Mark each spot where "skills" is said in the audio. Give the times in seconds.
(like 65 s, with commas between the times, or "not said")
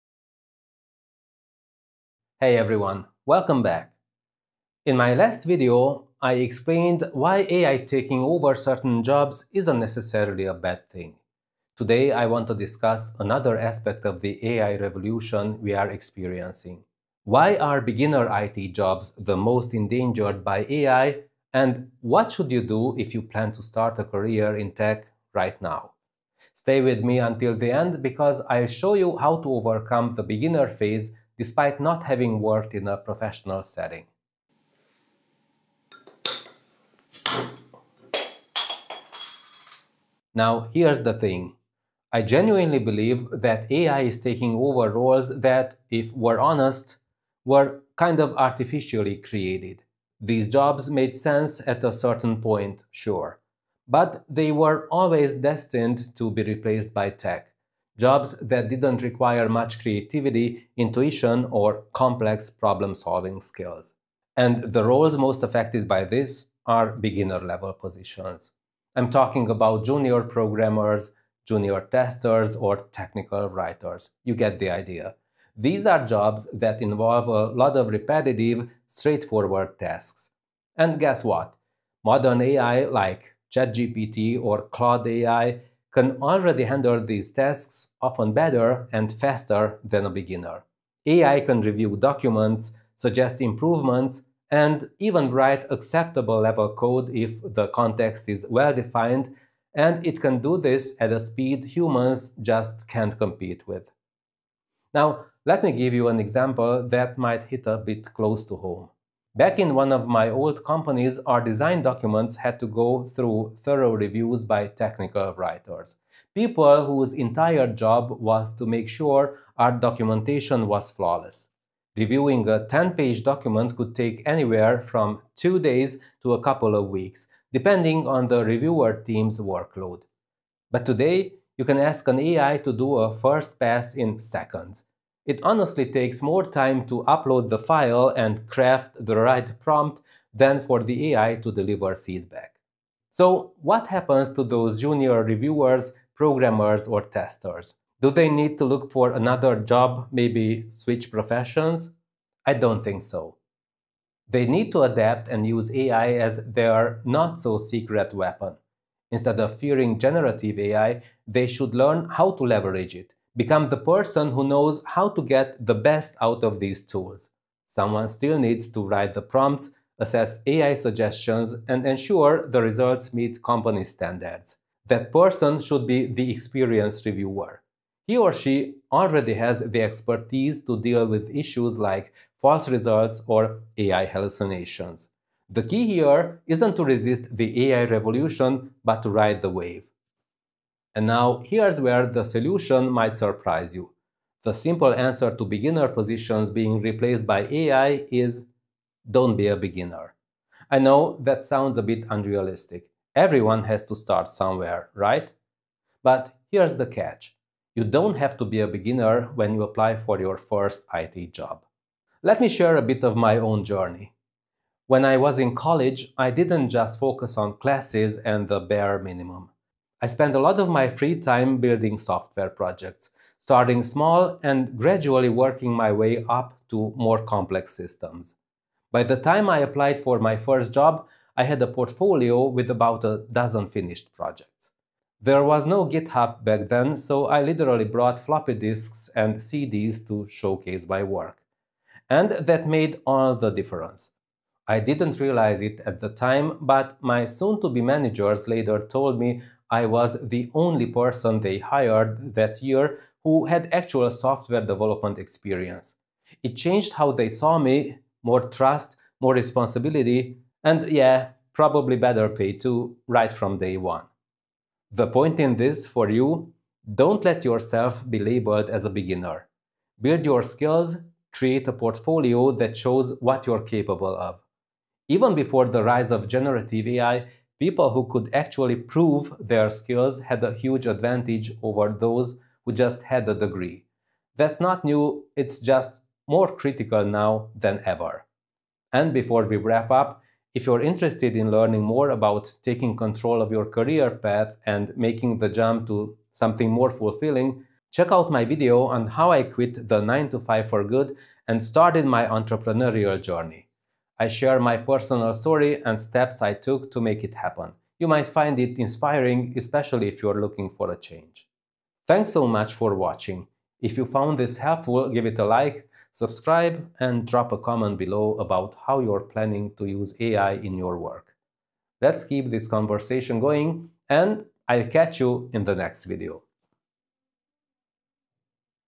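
63 s, 270 s, 279 s.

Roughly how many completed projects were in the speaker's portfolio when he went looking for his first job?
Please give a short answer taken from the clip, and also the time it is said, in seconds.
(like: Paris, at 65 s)
about a dozen, at 232 s.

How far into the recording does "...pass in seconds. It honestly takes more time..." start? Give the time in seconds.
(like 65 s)
133 s.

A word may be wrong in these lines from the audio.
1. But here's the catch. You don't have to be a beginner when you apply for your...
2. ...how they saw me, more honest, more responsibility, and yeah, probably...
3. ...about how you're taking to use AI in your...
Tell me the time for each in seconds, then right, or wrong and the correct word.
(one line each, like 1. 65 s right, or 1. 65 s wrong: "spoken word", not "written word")
1. 206 s right
2. 256 s wrong: "trust", not "honest"
3. 318 s wrong: "planning", not "taking".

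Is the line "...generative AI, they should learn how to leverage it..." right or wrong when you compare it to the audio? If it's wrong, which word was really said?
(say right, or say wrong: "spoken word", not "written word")
right.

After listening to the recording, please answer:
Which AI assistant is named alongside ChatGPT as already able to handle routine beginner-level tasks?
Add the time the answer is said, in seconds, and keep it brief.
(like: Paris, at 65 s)
Claude AI, at 84 s.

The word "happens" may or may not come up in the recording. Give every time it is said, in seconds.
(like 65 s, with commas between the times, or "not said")
143 s, 307 s.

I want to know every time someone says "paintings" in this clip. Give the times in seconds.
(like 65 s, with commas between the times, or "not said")
not said.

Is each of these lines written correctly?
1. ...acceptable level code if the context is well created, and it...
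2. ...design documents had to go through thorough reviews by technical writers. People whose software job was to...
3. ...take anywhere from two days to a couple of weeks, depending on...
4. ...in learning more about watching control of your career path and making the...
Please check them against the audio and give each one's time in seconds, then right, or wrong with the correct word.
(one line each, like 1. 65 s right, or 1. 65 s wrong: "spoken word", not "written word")
1. 95 s wrong: "defined", not "created"
2. 111 s wrong: "entire", not "software"
3. 123 s right
4. 291 s wrong: "taking", not "watching".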